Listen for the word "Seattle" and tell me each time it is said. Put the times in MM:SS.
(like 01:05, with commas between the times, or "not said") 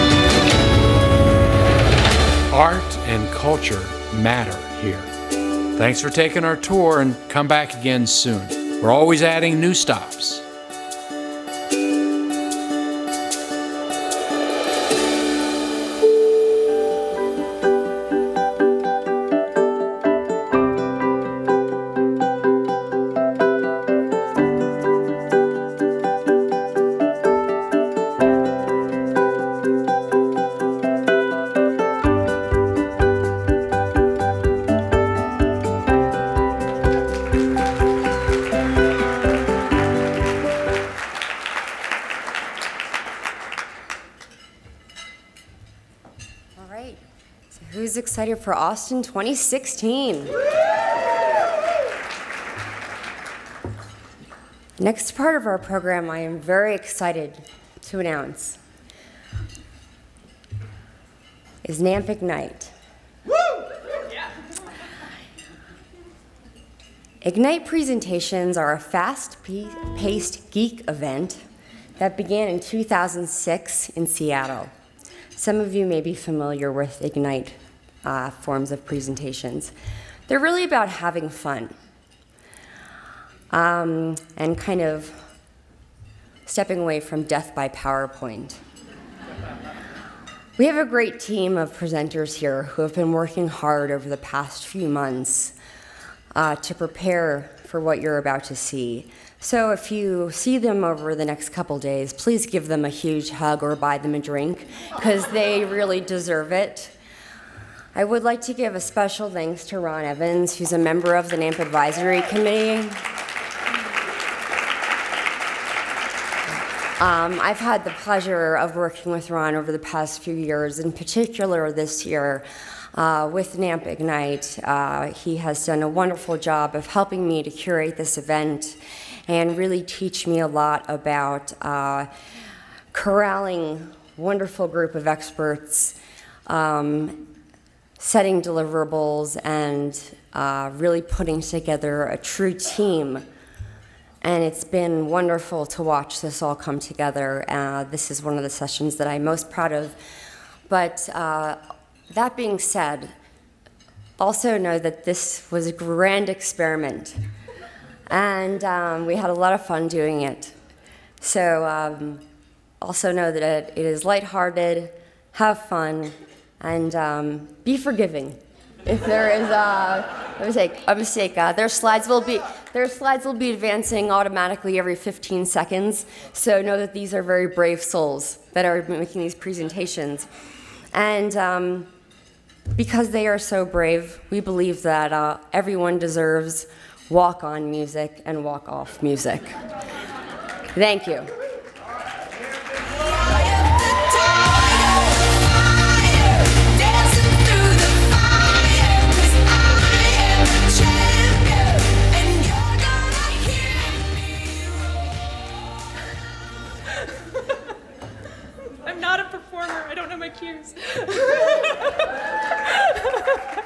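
01:14.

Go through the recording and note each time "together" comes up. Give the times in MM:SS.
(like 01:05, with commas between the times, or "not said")
02:21, 02:26.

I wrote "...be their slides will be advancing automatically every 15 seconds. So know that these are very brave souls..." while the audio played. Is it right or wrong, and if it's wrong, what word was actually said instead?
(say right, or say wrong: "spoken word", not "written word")
right.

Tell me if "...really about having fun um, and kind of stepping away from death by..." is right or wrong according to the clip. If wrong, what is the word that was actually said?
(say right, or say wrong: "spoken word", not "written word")
right.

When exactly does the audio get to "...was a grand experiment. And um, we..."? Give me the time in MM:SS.
02:35.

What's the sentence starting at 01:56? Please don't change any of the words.
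Um, I've had the pleasure of working with Ron over the past few years, in particular this year uh, with NAMP Ignite.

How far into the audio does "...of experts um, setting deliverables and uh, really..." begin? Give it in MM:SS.
02:14.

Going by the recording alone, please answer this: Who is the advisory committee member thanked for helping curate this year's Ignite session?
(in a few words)
Ron Evans.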